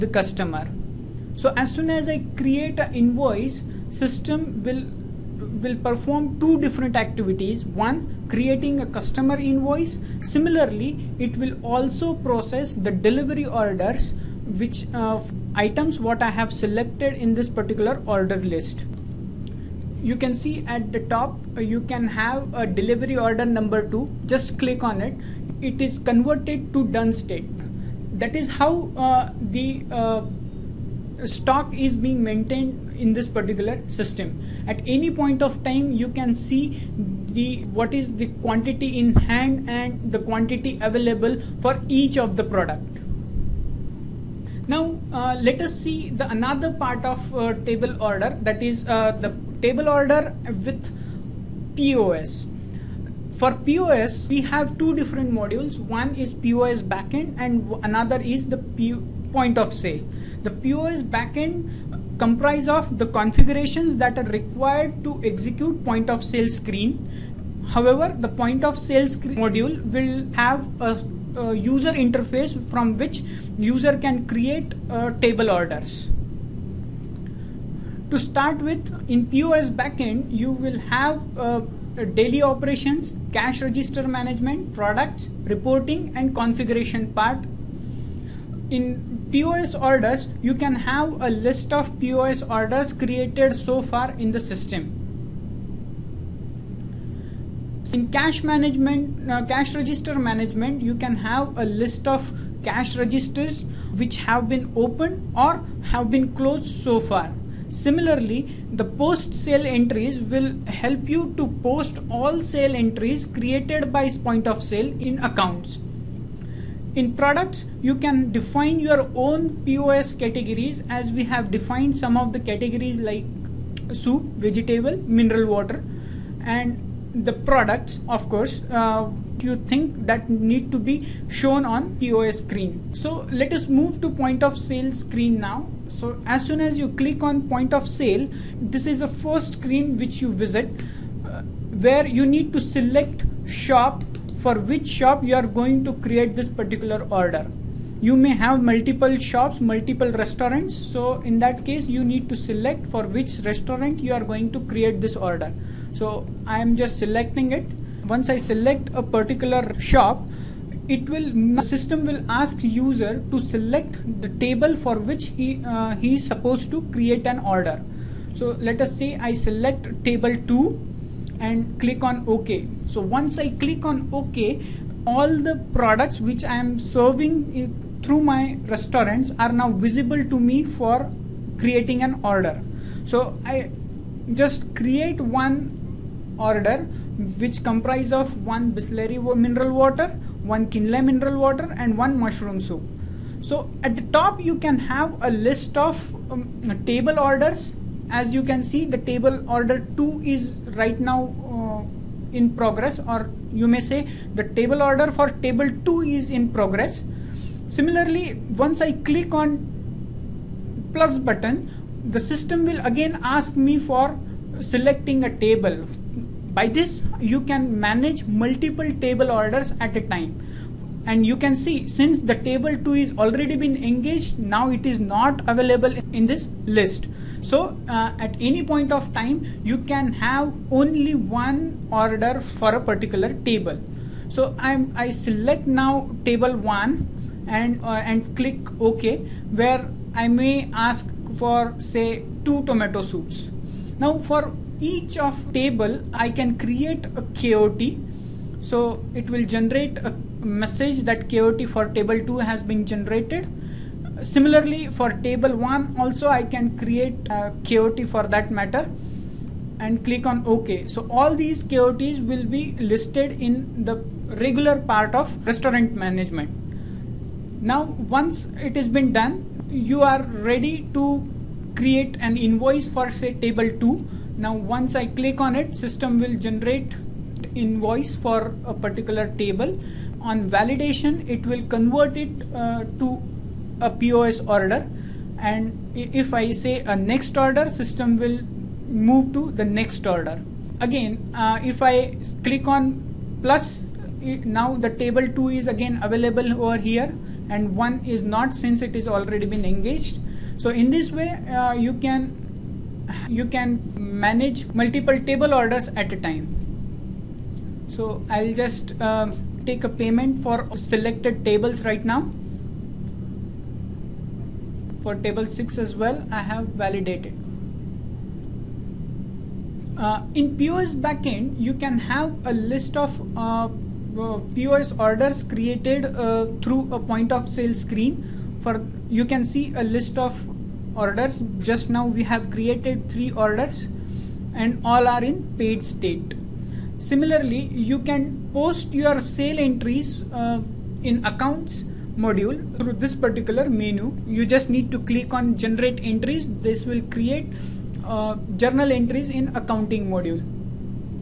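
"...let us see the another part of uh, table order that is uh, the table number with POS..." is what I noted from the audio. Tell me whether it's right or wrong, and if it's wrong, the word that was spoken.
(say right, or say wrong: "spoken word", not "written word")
wrong: "order", not "number".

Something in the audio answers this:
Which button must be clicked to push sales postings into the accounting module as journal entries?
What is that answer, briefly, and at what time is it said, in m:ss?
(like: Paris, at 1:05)
generate entries, at 5:45.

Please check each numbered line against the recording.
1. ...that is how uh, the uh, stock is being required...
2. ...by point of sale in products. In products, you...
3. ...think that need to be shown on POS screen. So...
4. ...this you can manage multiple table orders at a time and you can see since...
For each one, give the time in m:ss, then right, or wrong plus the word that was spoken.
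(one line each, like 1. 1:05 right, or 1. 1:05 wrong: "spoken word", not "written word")
1. 0:28 wrong: "maintained", not "required"
2. 1:53 wrong: "accounts", not "products"
3. 2:09 right
4. 3:36 right.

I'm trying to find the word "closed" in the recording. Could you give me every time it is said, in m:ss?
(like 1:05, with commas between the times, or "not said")
1:46.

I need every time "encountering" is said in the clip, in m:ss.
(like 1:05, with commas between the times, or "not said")
not said.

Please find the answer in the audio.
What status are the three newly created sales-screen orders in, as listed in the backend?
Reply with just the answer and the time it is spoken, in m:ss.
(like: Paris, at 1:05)
paid, at 5:35.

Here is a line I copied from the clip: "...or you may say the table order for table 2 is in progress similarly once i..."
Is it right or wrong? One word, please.
right.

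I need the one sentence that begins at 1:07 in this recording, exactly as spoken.
However, the point of sale screen module will have a, a user interface from which user can create uh, table orders.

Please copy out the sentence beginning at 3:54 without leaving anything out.
So I'm, I select now table one and, uh, and click OK, where I may ask for say two tomato soups.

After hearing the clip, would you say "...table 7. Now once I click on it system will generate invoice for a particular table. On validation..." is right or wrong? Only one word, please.
wrong.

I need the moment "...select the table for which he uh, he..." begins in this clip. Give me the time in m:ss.
2:43.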